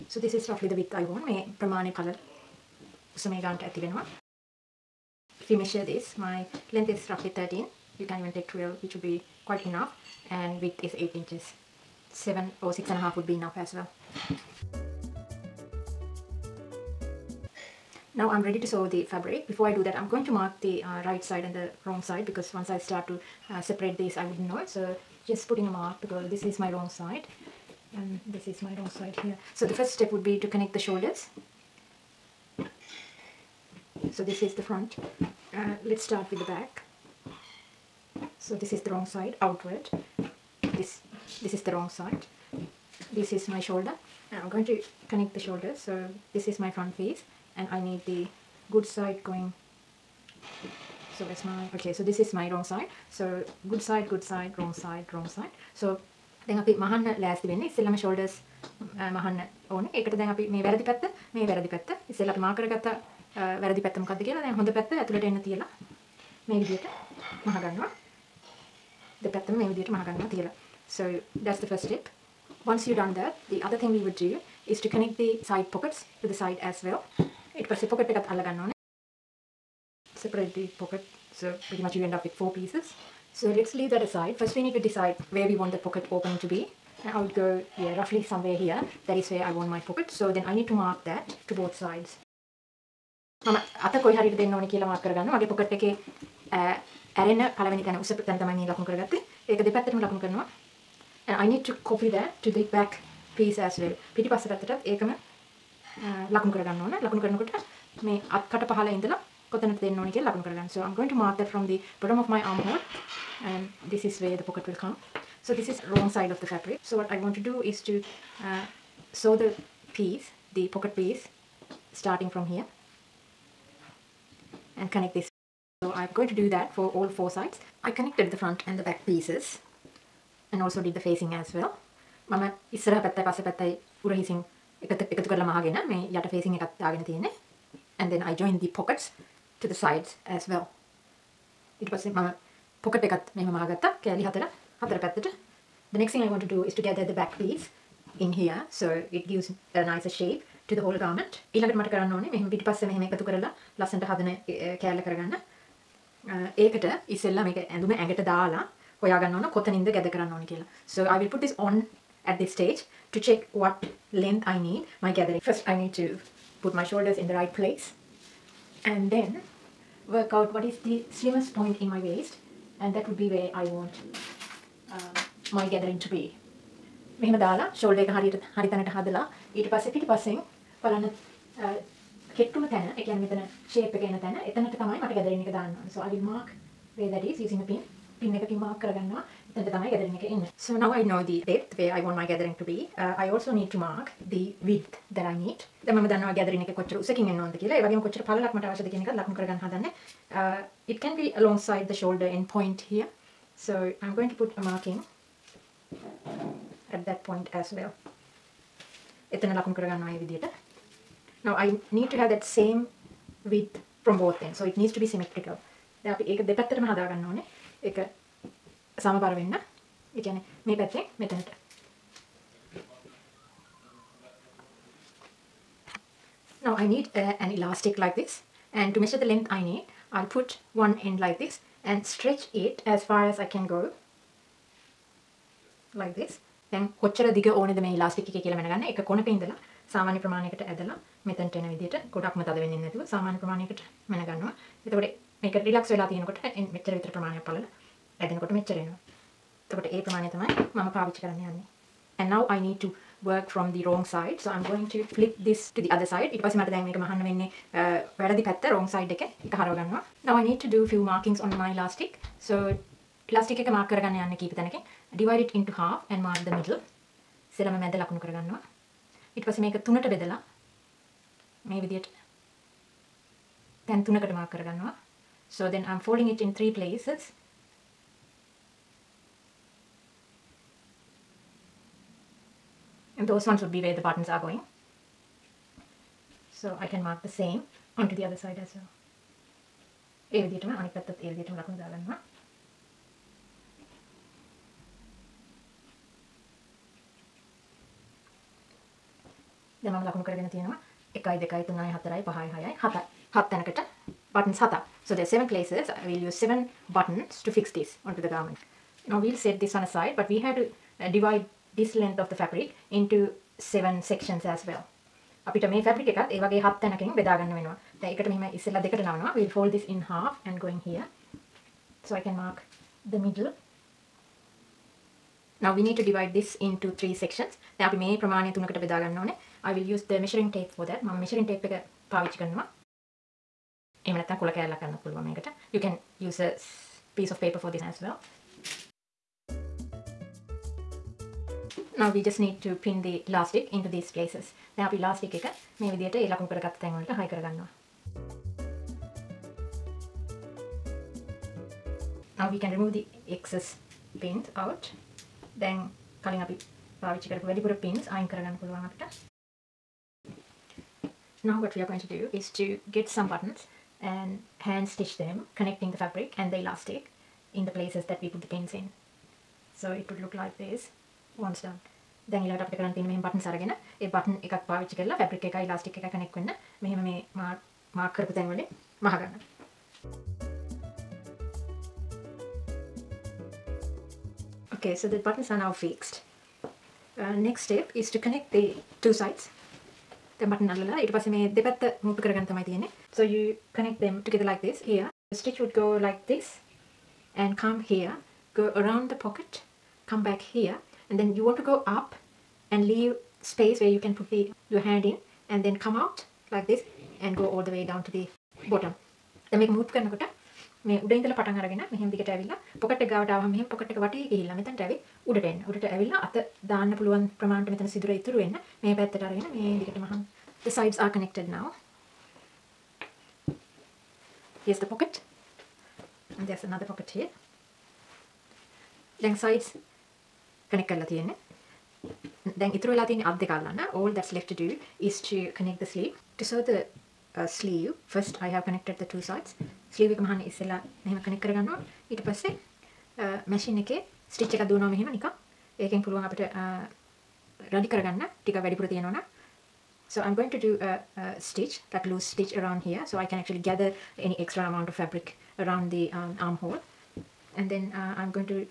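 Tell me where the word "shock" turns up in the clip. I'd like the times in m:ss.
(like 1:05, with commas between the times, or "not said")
not said.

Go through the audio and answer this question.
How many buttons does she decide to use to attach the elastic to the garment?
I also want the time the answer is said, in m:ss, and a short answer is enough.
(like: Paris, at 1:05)
7, at 5:06.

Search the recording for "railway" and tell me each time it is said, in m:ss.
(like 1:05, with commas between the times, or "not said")
not said.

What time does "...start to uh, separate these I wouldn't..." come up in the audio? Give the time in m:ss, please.
0:22.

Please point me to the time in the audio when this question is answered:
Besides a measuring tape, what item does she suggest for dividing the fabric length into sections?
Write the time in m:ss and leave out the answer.
5:36.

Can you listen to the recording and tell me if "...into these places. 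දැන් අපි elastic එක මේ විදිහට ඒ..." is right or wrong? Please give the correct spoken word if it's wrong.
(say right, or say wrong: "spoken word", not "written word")
right.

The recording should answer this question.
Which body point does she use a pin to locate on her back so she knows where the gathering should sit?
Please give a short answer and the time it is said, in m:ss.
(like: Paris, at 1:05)
slimmest point in my waist, at 2:51.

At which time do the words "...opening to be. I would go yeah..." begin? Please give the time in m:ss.
1:26.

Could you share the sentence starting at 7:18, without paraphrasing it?
First, I have connected the two sides.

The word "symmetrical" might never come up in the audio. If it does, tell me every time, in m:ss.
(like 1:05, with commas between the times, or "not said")
3:35.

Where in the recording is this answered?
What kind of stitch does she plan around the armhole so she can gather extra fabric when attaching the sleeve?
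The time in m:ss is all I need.
7:32.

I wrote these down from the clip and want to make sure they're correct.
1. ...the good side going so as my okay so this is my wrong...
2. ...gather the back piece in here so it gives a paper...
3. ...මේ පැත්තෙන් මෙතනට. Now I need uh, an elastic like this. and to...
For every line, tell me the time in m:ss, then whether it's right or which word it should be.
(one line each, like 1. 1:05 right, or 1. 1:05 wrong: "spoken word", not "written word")
1. 0:48 right
2. 2:26 wrong: "nicer", not "paper"
3. 3:40 right.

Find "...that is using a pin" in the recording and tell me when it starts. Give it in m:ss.
3:07.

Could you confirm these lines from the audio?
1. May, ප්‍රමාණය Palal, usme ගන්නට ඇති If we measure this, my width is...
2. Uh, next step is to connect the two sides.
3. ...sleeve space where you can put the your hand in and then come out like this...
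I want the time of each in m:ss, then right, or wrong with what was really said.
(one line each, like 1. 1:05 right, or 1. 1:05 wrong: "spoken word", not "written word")
1. 0:01 wrong: "length", not "width"
2. 6:27 right
3. 6:42 wrong: "leave", not "sleeve".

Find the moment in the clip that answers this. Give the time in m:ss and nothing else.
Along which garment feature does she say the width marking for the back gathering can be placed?
3:21.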